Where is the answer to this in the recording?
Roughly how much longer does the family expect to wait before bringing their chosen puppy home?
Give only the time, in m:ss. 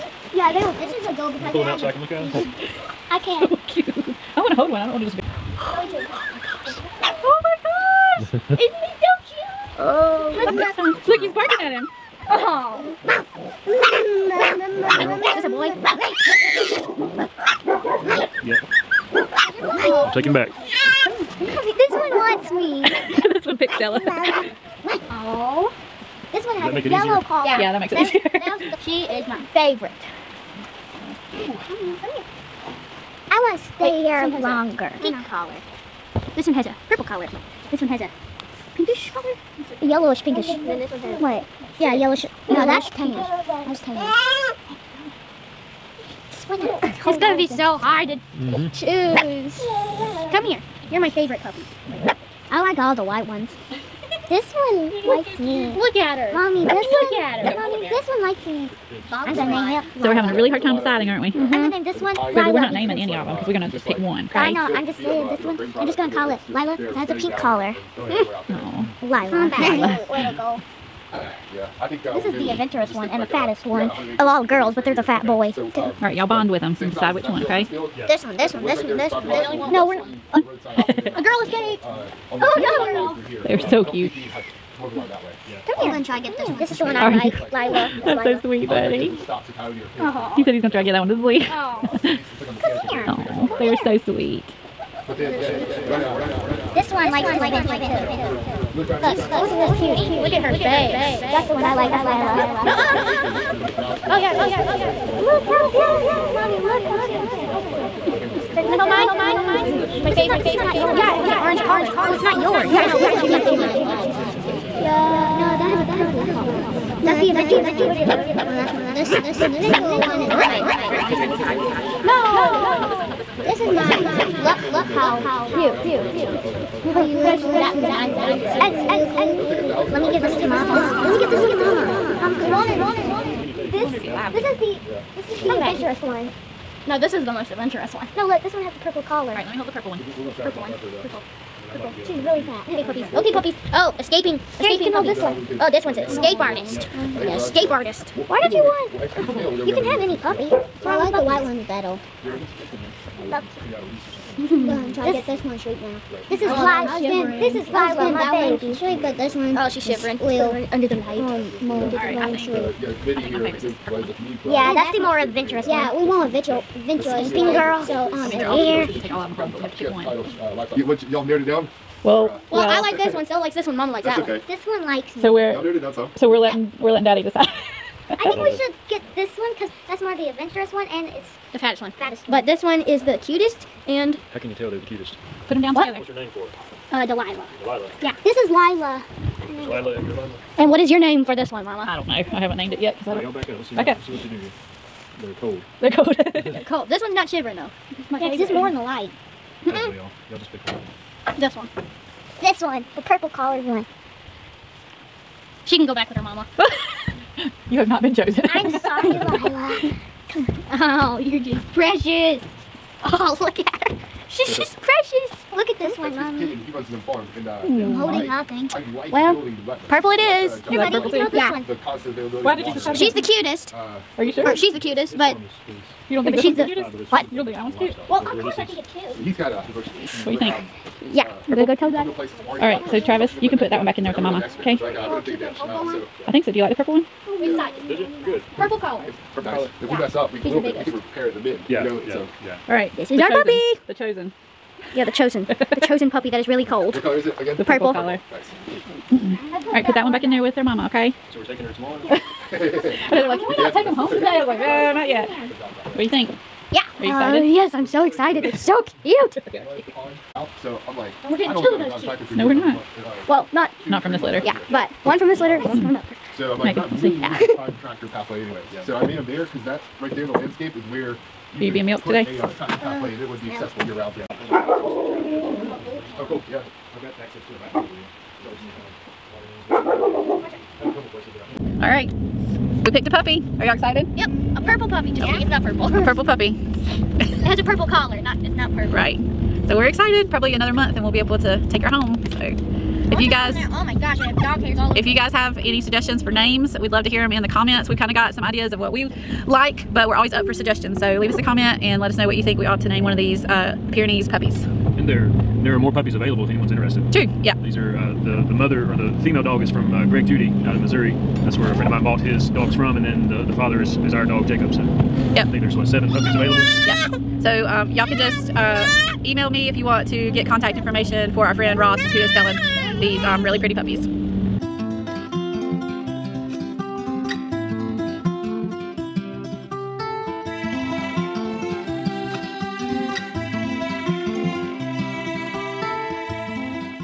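4:50.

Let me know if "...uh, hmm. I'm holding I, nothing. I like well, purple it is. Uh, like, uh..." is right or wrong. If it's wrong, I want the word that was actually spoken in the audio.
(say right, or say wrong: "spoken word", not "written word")
right.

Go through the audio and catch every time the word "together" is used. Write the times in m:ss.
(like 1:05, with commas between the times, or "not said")
3:05.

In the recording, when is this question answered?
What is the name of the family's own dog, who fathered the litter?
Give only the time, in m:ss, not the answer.
5:14.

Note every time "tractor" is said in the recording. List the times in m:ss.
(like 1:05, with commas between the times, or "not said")
4:27, 4:32.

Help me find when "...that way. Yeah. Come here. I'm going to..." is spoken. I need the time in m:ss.
1:24.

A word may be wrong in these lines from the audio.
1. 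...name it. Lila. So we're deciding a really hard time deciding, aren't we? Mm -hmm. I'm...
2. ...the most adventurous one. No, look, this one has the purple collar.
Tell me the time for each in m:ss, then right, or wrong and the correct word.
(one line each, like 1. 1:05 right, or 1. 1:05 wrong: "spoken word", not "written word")
1. 0:59 wrong: "having", not "deciding"
2. 2:17 right.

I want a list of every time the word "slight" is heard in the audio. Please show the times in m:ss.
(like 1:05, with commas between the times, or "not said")
not said.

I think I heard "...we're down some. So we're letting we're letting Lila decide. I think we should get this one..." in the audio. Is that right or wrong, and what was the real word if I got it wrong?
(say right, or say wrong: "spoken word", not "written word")
wrong: "Daddy", not "Lila".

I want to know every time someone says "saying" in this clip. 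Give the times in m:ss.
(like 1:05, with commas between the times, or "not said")
1:05.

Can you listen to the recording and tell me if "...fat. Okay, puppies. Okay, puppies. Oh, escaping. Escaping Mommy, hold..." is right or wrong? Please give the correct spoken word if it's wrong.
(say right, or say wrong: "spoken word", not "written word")
wrong: "Here", not "Mommy".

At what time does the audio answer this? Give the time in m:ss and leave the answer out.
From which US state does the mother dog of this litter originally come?
5:10.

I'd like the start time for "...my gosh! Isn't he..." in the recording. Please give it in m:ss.
0:07.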